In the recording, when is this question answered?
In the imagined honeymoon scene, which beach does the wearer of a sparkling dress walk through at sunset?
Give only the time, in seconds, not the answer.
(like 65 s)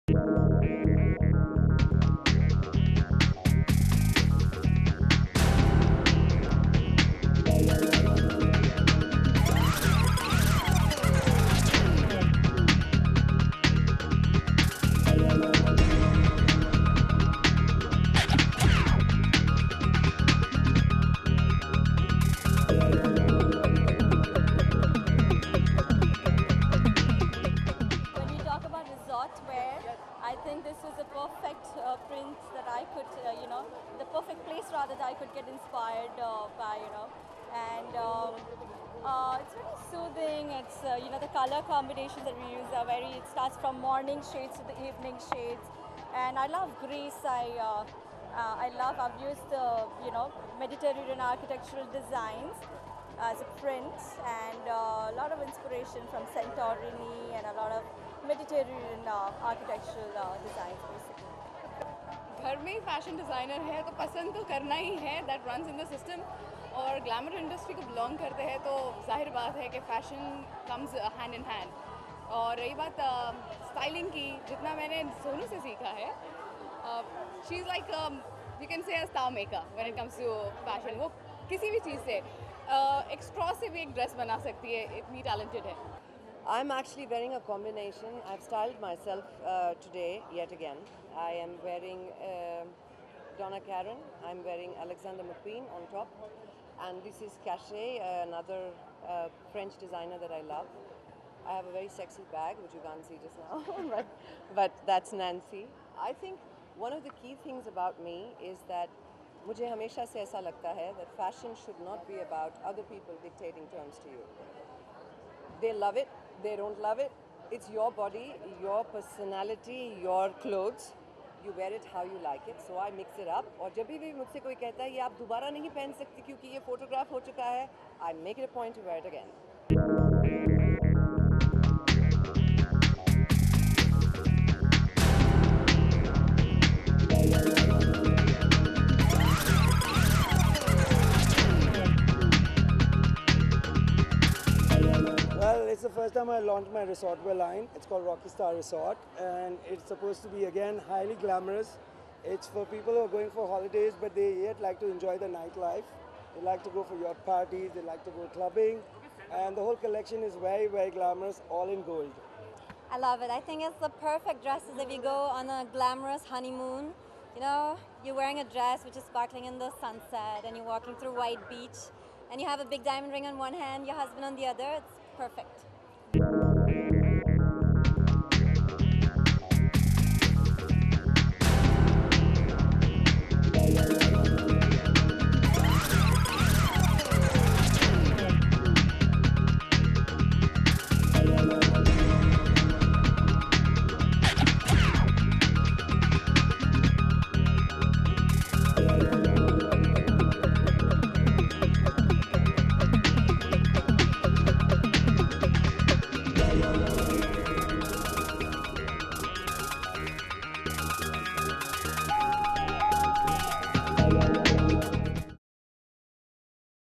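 171 s.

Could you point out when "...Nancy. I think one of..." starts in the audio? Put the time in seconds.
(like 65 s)
105 s.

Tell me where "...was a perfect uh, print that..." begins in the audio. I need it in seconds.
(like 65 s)
30 s.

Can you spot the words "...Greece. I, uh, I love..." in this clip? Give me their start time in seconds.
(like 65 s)
46 s.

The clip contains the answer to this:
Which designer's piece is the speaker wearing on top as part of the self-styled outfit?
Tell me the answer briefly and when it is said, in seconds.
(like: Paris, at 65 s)
Alexander McQueen, at 94 s.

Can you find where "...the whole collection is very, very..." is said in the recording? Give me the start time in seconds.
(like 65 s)
159 s.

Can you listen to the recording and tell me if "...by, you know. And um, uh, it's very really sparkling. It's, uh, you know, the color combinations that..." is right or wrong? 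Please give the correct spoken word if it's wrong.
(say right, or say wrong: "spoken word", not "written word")
wrong: "soothing", not "sparkling".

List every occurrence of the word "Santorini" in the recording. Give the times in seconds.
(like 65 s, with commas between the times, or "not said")
56 s.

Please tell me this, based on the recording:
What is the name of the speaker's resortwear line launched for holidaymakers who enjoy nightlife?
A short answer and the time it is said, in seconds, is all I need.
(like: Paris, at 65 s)
Rocky Star Resort, at 148 s.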